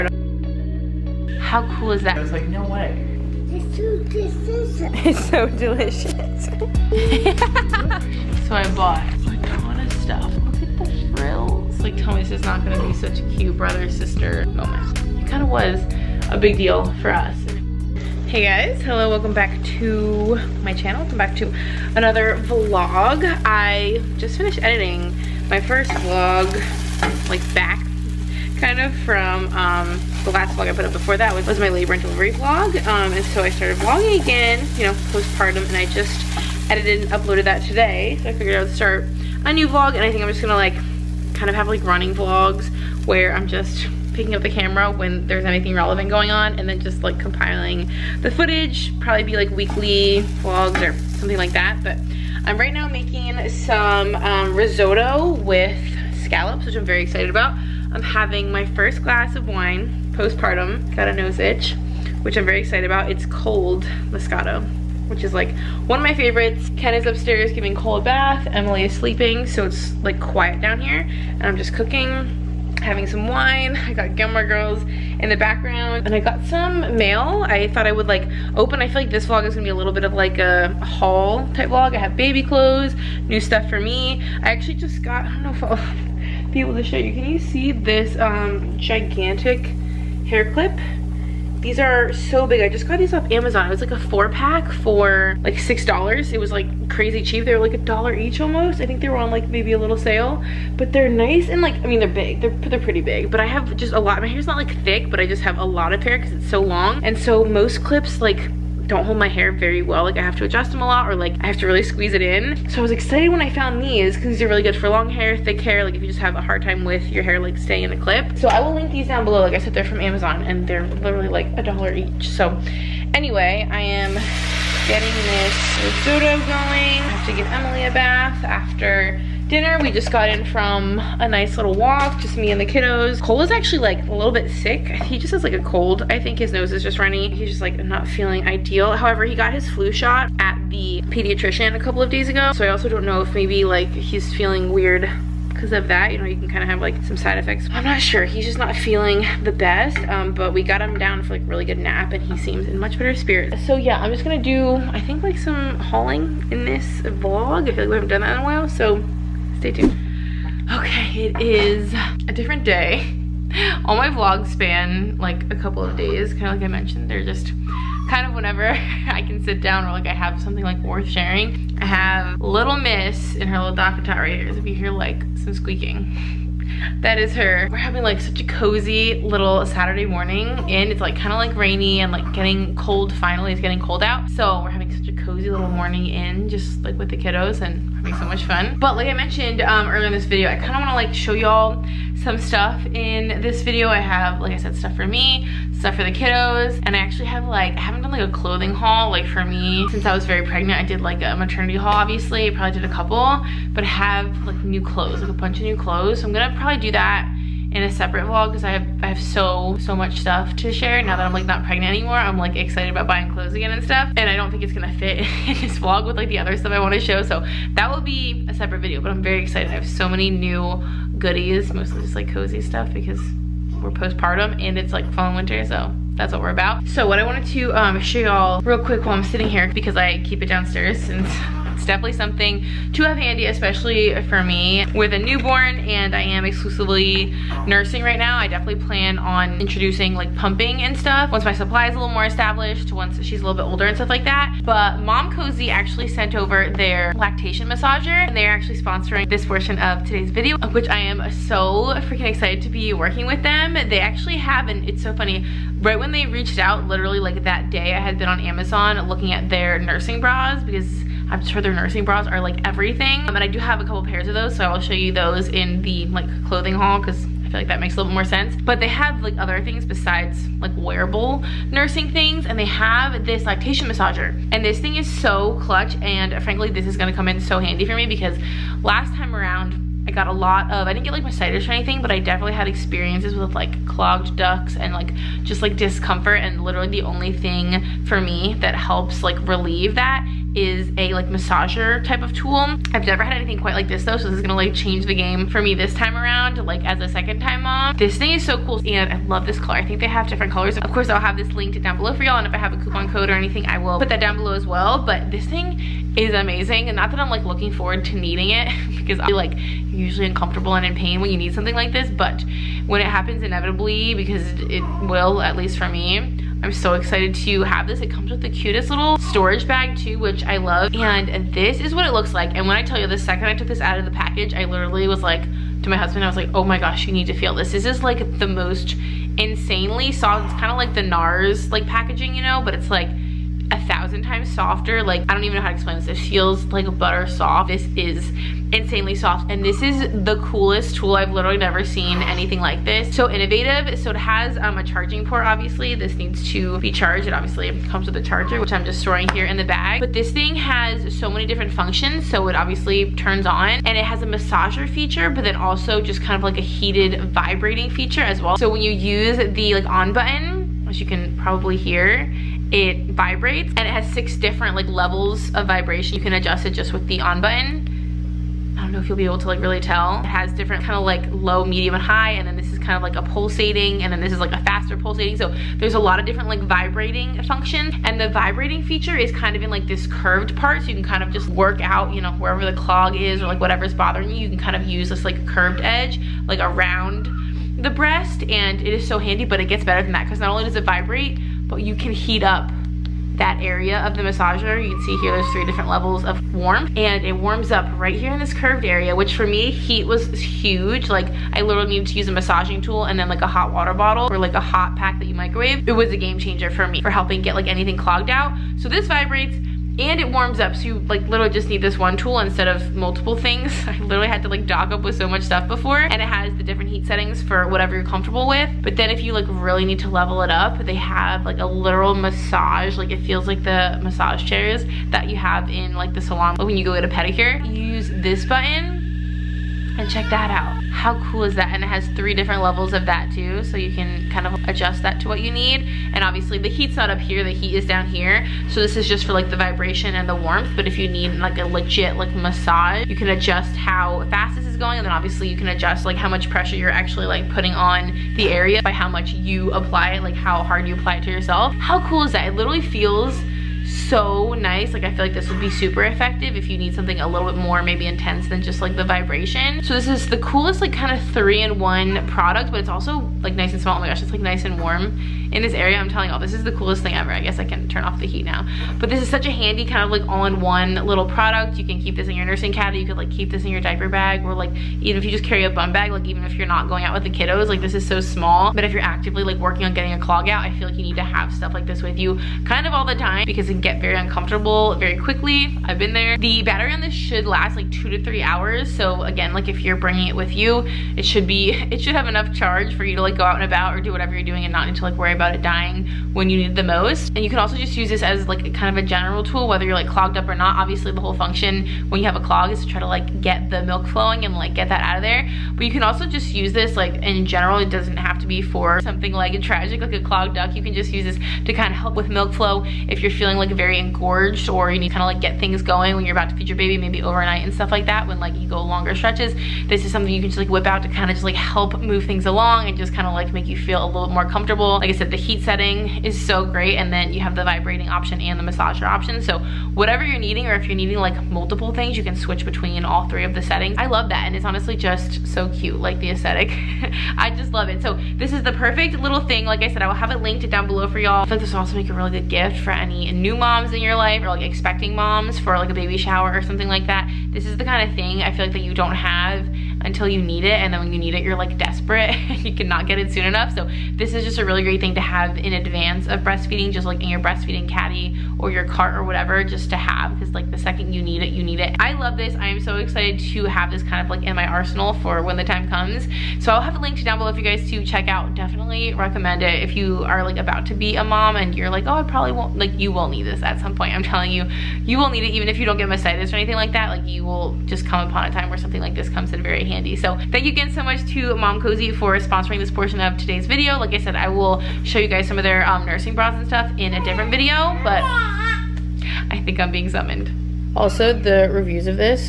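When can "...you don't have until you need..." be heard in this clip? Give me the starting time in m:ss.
9:08.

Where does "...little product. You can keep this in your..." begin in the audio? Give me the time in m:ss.
7:50.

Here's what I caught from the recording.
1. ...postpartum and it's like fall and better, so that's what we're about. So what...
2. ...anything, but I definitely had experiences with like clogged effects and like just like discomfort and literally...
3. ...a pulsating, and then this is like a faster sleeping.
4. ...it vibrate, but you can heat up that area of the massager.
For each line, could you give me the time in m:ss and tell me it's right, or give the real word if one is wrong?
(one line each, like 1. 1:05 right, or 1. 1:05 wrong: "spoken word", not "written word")
1. 3:43 wrong: "winter", not "better"
2. 4:41 wrong: "ducts", not "effects"
3. 6:13 wrong: "pulsating", not "sleeping"
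4. 6:30 right.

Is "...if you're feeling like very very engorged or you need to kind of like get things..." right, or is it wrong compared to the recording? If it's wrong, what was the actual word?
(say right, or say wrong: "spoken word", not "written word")
right.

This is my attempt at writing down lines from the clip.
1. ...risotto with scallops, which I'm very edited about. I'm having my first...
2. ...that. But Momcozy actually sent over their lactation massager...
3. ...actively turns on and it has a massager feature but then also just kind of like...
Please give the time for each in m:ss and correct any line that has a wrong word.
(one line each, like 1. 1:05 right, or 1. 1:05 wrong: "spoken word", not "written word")
1. 0:54 wrong: "excited", not "edited"
2. 4:04 right
3. 5:52 wrong: "obviously", not "actively".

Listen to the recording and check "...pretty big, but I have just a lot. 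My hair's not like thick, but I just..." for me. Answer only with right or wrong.
right.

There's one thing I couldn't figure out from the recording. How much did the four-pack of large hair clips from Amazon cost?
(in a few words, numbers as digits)
$6.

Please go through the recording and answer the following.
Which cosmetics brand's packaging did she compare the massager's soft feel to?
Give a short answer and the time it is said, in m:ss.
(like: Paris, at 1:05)
NARS, at 5:31.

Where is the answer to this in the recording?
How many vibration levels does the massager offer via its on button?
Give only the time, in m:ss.
6:04.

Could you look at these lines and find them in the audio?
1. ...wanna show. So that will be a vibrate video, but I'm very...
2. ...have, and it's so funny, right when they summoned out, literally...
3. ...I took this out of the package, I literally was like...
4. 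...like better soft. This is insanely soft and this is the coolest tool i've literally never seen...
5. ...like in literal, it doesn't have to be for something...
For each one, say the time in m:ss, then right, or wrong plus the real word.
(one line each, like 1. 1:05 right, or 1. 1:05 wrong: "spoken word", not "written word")
1. 3:36 wrong: "separate", not "vibrate"
2. 4:14 wrong: "reached", not "summoned"
3. 5:23 right
4. 5:36 wrong: "butter", not "better"
5. 8:26 wrong: "general", not "literal".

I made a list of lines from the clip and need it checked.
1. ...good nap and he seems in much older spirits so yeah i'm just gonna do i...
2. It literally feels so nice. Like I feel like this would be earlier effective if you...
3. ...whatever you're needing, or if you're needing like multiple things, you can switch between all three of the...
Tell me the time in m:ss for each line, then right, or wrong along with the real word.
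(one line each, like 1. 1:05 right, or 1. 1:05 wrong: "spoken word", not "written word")
1. 2:31 wrong: "better", not "older"
2. 7:32 wrong: "super", not "earlier"
3. 8:49 right.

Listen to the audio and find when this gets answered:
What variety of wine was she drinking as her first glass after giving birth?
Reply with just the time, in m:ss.
1:04.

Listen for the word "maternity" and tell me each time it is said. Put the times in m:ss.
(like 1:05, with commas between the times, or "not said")
3:21.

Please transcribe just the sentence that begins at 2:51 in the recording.
I have Little Miss in her little DockATot right here.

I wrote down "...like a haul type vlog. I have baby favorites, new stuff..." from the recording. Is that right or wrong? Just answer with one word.
wrong.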